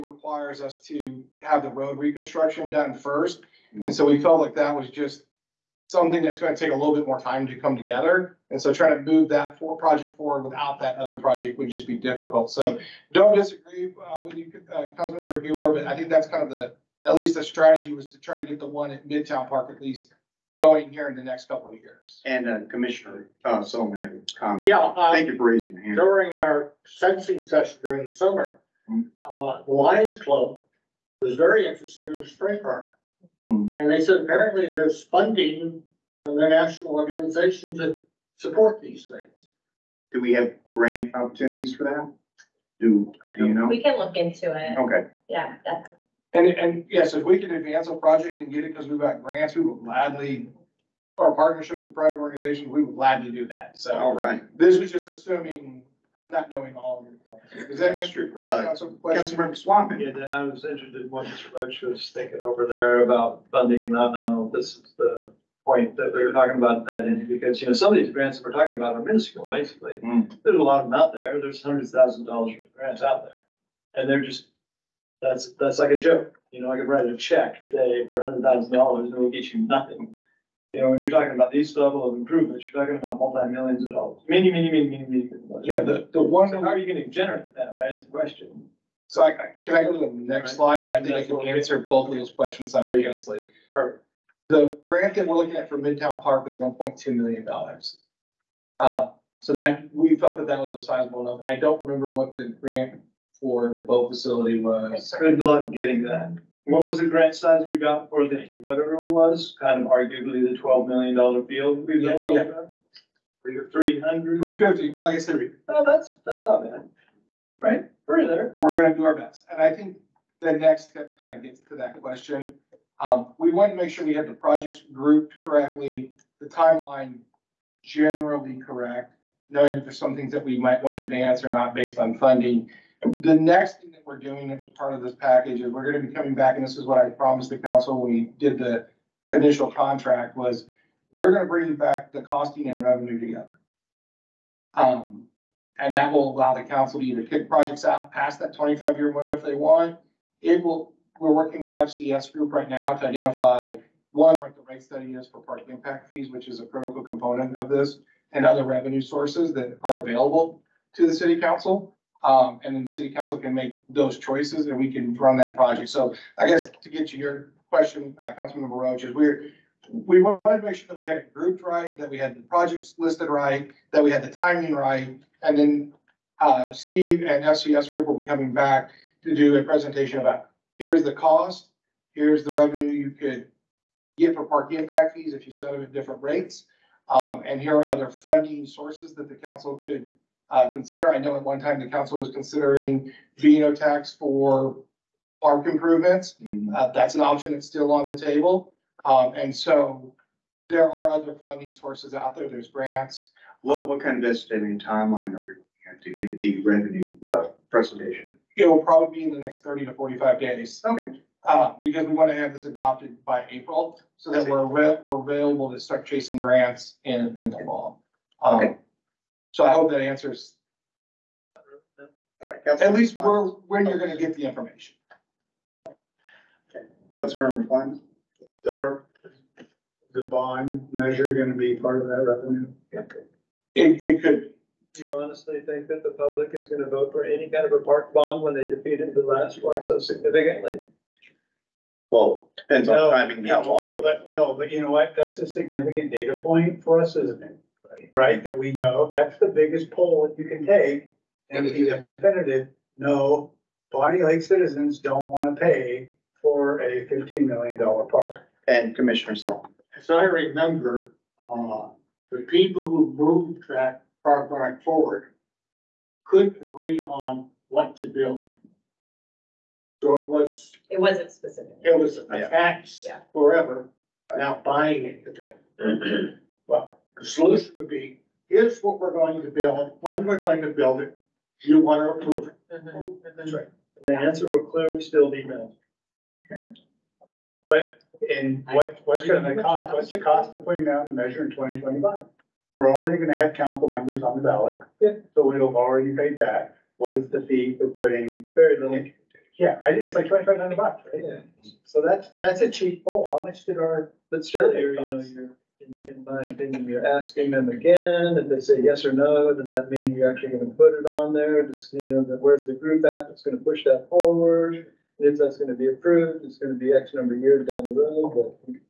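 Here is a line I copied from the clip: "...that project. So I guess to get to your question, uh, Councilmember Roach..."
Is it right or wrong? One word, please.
right.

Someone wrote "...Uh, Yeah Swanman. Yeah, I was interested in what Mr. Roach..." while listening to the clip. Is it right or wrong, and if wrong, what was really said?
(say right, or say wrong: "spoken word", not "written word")
wrong: "Councilmember", not "Yeah".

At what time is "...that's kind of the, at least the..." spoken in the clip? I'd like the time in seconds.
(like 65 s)
16 s.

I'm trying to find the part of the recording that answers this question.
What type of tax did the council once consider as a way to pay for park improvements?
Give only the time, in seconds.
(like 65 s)
193 s.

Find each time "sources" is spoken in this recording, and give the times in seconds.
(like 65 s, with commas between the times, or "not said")
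159 s, 188 s, 201 s.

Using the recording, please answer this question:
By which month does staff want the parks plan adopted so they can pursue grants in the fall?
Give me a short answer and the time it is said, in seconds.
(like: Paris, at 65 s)
April, at 213 s.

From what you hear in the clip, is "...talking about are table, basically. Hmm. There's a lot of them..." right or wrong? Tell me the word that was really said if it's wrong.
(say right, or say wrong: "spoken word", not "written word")
wrong: "minuscule", not "table".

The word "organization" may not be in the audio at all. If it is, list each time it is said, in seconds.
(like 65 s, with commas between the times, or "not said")
36 s, 52 s.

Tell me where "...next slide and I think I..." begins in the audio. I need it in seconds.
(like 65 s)
90 s.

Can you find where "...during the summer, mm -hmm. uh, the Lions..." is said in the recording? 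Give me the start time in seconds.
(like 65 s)
27 s.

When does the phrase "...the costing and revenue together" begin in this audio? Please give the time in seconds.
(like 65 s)
142 s.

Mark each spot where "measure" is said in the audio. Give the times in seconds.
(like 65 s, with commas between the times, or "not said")
230 s, 291 s.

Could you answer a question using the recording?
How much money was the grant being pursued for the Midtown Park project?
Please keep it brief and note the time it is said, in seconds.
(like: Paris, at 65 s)
$1.2 million, at 96 s.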